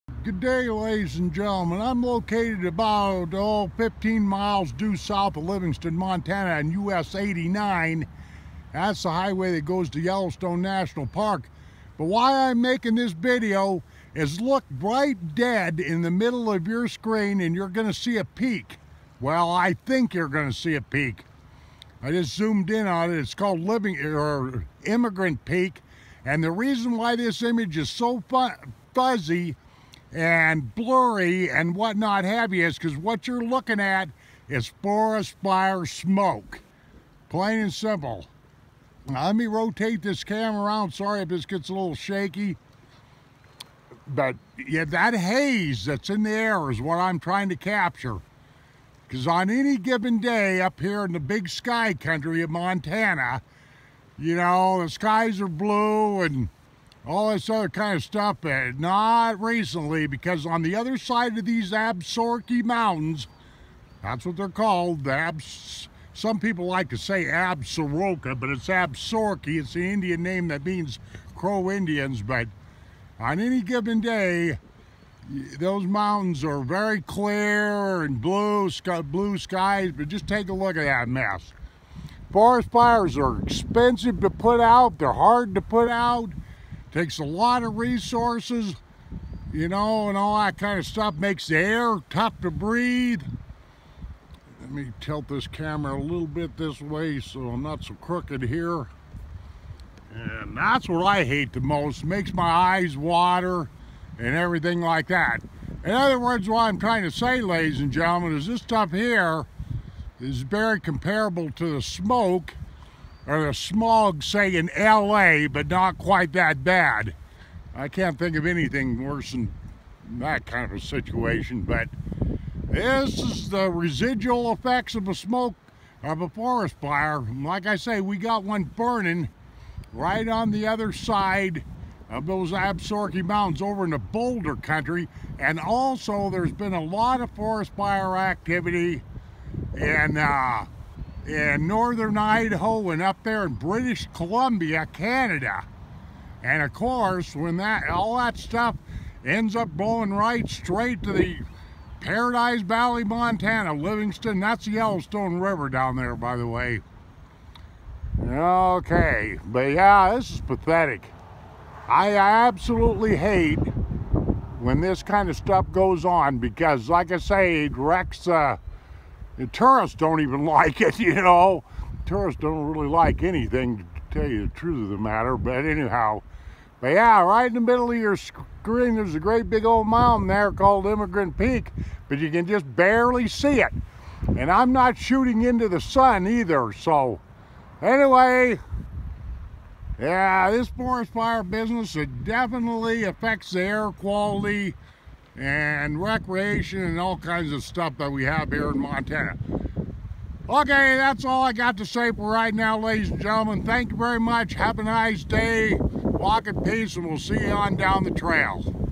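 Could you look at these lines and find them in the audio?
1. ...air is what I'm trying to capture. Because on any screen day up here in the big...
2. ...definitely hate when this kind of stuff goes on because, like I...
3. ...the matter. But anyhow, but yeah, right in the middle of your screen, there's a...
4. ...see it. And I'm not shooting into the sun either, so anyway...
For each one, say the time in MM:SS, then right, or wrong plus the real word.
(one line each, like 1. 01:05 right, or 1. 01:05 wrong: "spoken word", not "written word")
1. 00:46 wrong: "given", not "screen"
2. 02:42 wrong: "absolutely", not "definitely"
3. 02:54 right
4. 03:03 right.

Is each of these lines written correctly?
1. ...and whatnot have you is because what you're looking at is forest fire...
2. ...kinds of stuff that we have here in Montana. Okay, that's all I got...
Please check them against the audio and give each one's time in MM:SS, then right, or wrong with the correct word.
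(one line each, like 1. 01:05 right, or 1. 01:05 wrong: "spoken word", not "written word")
1. 00:31 right
2. 03:17 right.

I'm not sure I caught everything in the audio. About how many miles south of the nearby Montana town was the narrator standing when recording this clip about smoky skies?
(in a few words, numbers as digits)
15.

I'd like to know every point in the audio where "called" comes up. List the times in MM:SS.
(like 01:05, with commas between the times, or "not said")
00:23, 01:04, 03:00.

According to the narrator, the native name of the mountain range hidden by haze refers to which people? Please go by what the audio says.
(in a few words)
Crow Indians.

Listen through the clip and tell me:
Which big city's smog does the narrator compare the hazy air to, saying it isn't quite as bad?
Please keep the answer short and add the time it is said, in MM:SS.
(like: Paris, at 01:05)
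LA, at 01:54.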